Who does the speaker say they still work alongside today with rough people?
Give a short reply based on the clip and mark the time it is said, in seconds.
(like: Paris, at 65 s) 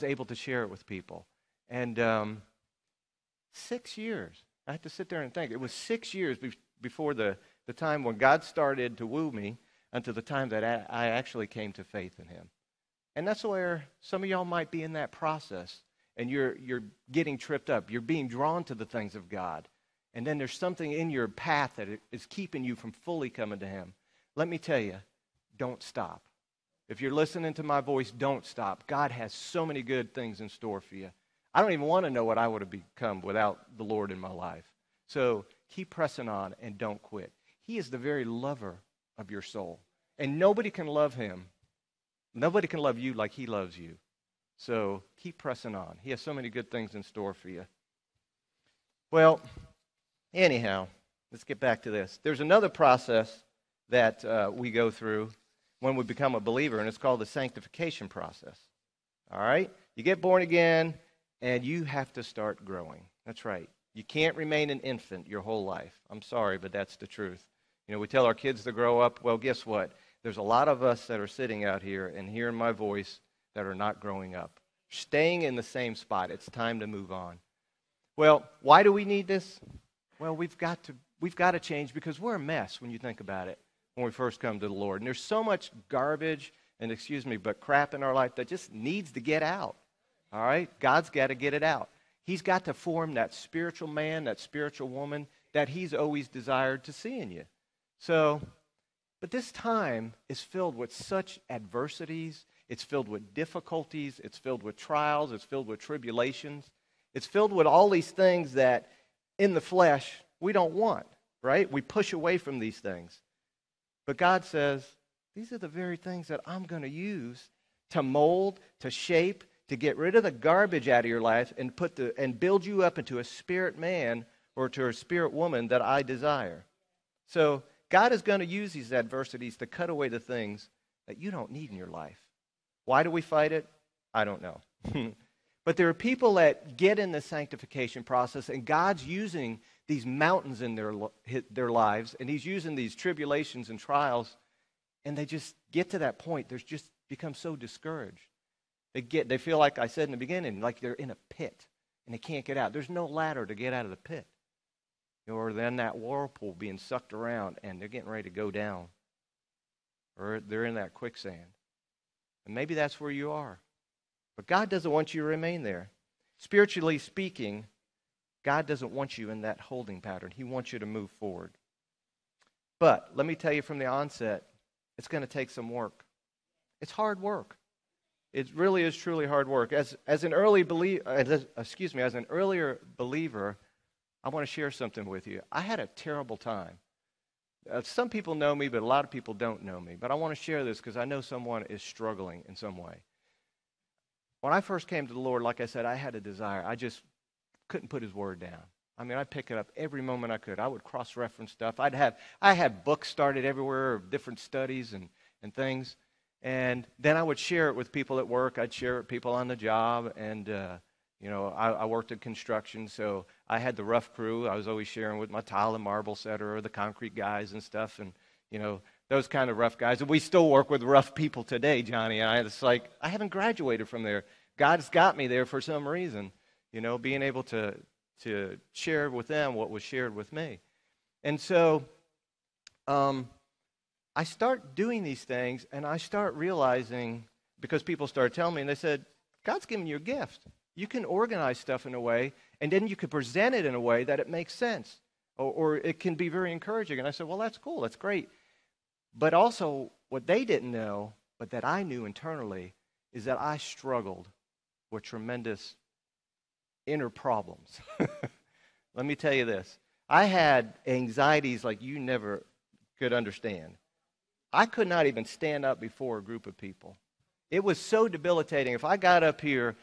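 Johnny, at 221 s.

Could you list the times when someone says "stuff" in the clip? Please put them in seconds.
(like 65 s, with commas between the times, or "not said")
201 s, 217 s, 241 s.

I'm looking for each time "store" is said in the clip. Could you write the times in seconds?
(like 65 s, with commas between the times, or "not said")
30 s, 47 s.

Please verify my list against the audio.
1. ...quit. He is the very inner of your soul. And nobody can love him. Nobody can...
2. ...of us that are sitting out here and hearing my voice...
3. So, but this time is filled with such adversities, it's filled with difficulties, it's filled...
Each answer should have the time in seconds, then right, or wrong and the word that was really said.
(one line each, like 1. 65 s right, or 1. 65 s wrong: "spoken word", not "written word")
1. 37 s wrong: "lover", not "inner"
2. 70 s right
3. 97 s right.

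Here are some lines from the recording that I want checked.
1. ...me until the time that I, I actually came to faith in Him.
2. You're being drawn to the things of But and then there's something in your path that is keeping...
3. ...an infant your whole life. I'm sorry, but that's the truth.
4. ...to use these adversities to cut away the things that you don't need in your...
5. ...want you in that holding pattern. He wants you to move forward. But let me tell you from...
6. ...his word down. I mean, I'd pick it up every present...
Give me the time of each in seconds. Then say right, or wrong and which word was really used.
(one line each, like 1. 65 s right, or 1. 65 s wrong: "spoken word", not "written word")
1. 9 s right
2. 17 s wrong: "God", not "But"
3. 64 s right
4. 128 s right
5. 168 s right
6. 198 s wrong: "moment", not "present".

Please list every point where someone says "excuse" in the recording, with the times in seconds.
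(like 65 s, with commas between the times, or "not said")
86 s, 181 s.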